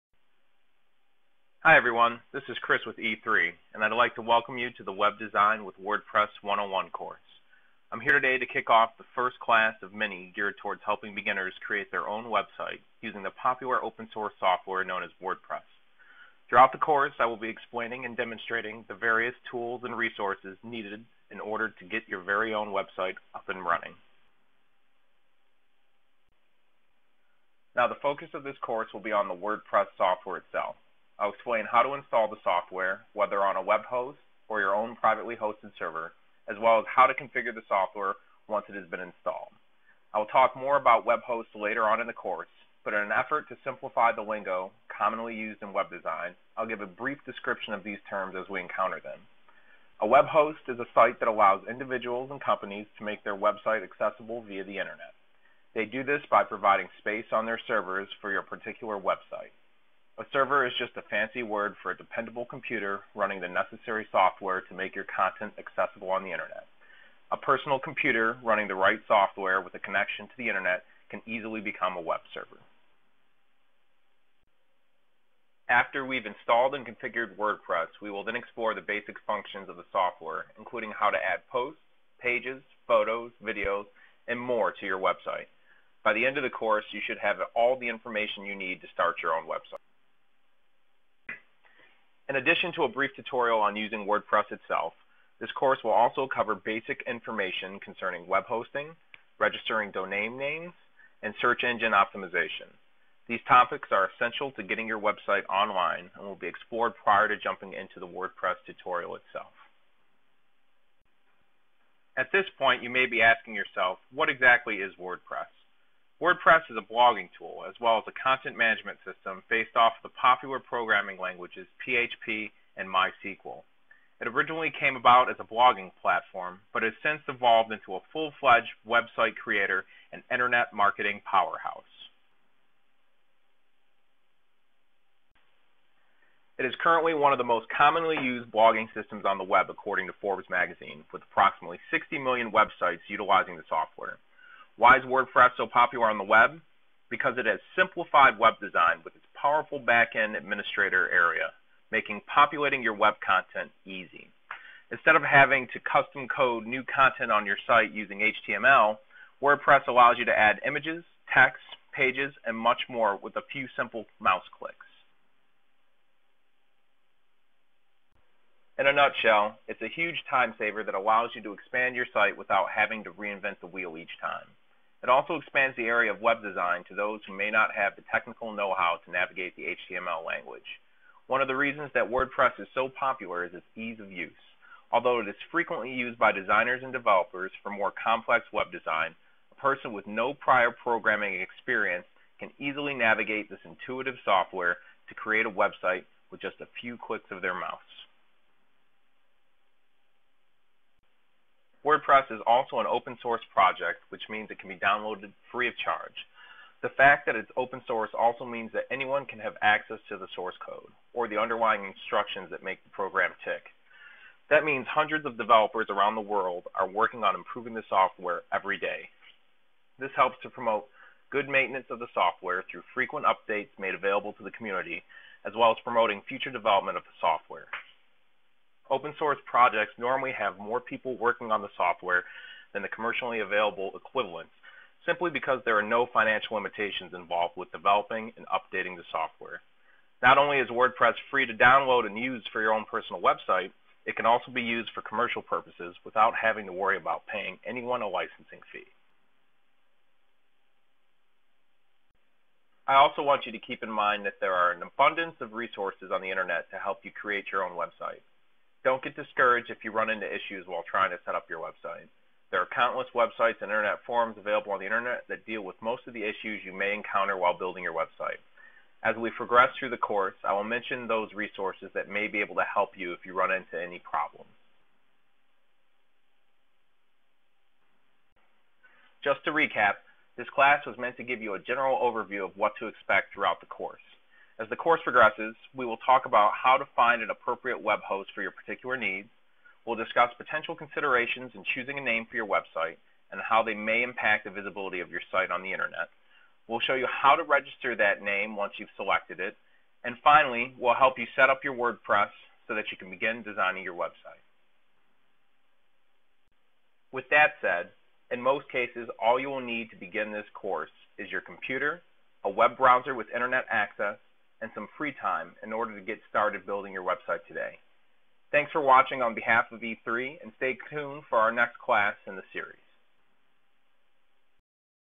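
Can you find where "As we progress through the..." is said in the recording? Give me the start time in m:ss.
4:29.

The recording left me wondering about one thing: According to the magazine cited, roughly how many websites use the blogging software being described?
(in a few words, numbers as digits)
60 million.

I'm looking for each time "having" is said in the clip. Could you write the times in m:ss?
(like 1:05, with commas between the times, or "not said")
2:35, 2:52, 4:06.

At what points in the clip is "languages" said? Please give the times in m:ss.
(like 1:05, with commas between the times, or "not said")
2:01, 3:00.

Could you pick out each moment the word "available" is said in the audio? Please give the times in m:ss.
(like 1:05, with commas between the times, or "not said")
3:43, 3:53, 4:24.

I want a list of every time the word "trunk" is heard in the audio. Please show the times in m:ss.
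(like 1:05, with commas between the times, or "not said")
not said.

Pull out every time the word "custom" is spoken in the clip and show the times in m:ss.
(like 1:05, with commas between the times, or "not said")
2:35.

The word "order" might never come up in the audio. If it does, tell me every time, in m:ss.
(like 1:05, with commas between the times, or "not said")
0:21, 5:15.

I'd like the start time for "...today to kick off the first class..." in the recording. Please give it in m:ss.
0:08.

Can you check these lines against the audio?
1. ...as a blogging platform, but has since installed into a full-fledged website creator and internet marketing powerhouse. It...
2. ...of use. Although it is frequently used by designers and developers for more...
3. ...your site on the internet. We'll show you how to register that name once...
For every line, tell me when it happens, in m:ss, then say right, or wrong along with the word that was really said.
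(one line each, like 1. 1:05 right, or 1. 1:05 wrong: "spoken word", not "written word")
1. 2:05 wrong: "evolved", not "installed"
2. 3:03 right
3. 4:55 right.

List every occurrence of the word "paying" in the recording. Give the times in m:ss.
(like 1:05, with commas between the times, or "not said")
4:07.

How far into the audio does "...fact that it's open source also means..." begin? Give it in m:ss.
3:26.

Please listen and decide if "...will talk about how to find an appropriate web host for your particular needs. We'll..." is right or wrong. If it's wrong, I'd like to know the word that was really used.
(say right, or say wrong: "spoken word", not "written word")
right.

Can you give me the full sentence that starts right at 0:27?
Now the focus of this course will be on the WordPress software itself.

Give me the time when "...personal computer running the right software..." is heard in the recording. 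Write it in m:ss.
1:07.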